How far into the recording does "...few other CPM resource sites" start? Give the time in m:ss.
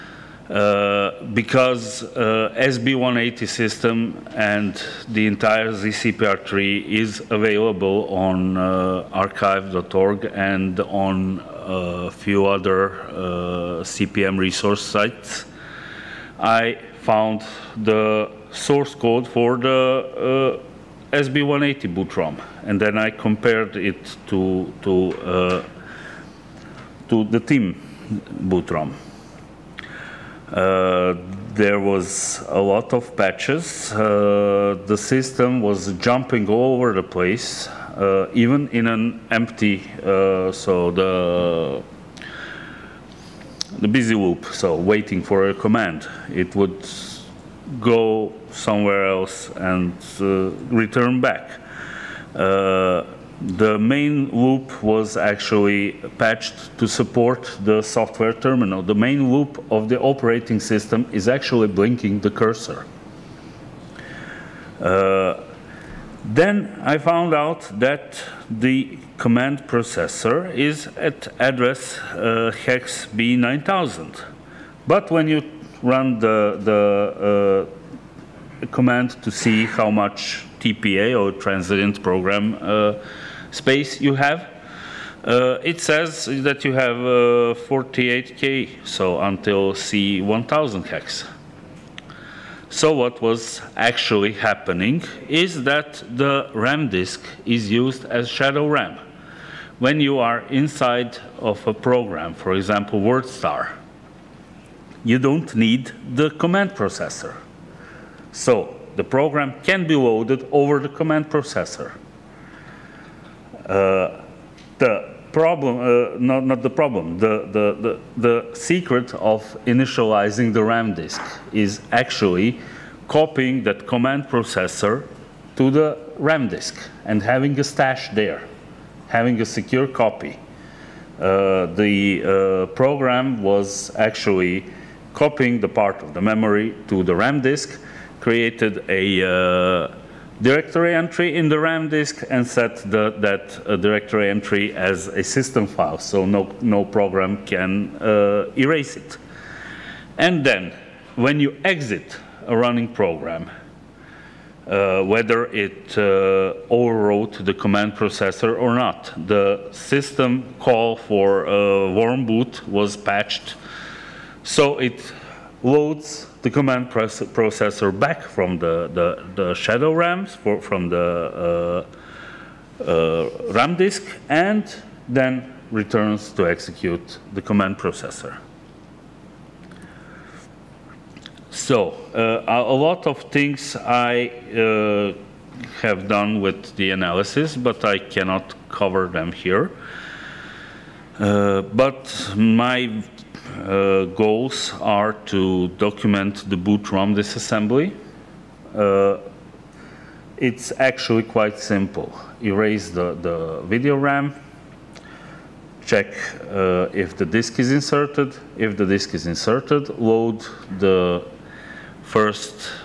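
0:12.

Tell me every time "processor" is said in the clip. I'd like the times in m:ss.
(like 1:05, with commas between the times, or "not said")
1:09, 1:46, 1:51, 2:04, 2:37, 2:46, 2:57.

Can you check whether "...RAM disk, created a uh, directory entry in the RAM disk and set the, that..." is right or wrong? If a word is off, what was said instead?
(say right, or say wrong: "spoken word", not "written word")
right.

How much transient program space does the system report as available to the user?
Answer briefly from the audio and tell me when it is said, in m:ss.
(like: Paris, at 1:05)
48k, at 1:27.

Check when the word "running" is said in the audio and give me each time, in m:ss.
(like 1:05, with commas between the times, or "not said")
2:32.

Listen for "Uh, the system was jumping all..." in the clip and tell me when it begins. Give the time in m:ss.
0:33.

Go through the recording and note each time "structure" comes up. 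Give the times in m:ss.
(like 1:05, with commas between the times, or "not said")
not said.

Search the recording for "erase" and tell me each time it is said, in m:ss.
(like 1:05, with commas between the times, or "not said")
2:28, 3:22.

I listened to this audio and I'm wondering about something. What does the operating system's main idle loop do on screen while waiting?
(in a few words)
Blinking the cursor.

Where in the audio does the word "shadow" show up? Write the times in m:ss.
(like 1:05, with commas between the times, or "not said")
1:38, 2:49.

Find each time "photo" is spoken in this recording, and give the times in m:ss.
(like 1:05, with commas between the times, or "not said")
not said.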